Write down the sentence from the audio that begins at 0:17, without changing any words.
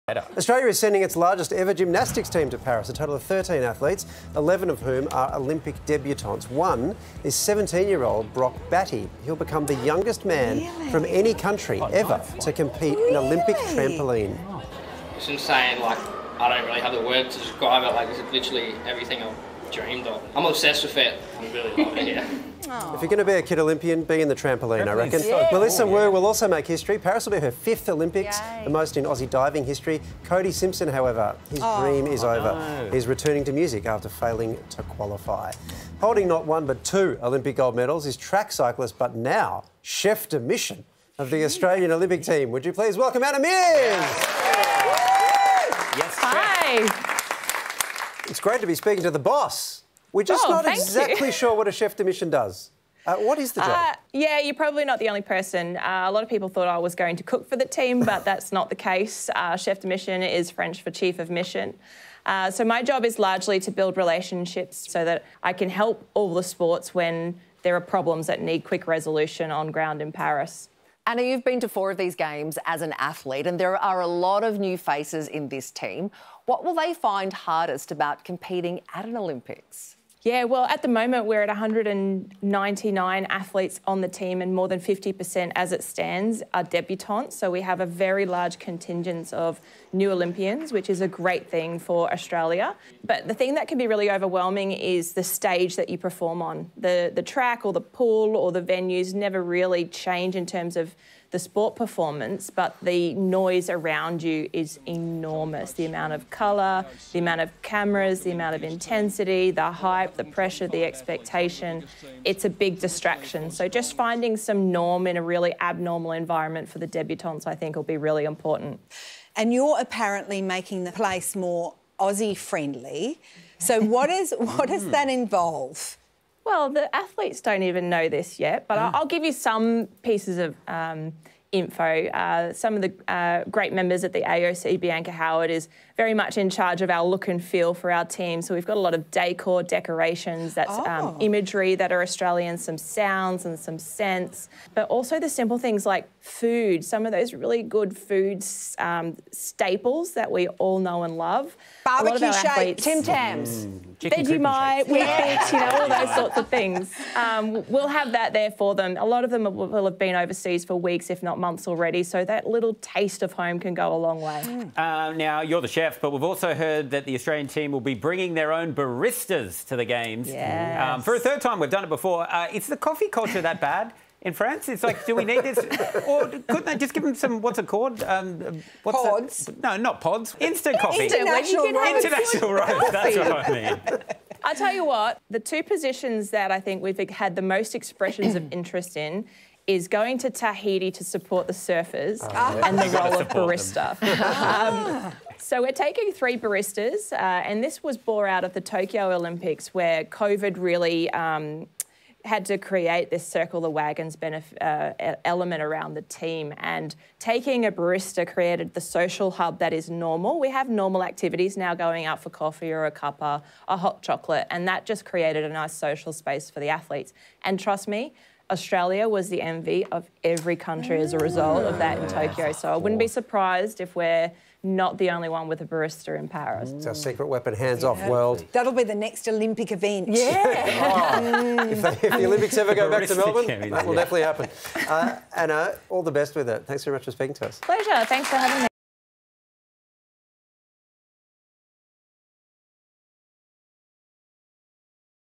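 Like, it's literally everything I've dreamed of.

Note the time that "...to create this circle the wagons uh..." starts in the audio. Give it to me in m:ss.
3:22.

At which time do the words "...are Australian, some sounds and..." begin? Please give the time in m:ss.
2:21.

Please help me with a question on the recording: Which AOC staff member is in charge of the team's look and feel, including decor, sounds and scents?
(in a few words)
Bianca Howard.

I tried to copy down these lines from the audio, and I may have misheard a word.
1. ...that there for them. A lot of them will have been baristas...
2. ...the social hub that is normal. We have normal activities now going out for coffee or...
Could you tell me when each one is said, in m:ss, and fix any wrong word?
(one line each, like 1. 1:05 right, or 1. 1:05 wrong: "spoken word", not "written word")
1. 2:38 wrong: "overseas", not "baristas"
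2. 3:28 right.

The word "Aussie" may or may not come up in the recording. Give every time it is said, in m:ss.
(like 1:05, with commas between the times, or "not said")
0:29, 2:01.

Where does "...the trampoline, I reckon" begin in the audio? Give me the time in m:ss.
0:24.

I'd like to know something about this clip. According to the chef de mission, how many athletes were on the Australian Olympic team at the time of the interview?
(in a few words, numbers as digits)
199.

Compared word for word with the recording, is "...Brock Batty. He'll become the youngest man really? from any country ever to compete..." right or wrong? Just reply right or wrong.
right.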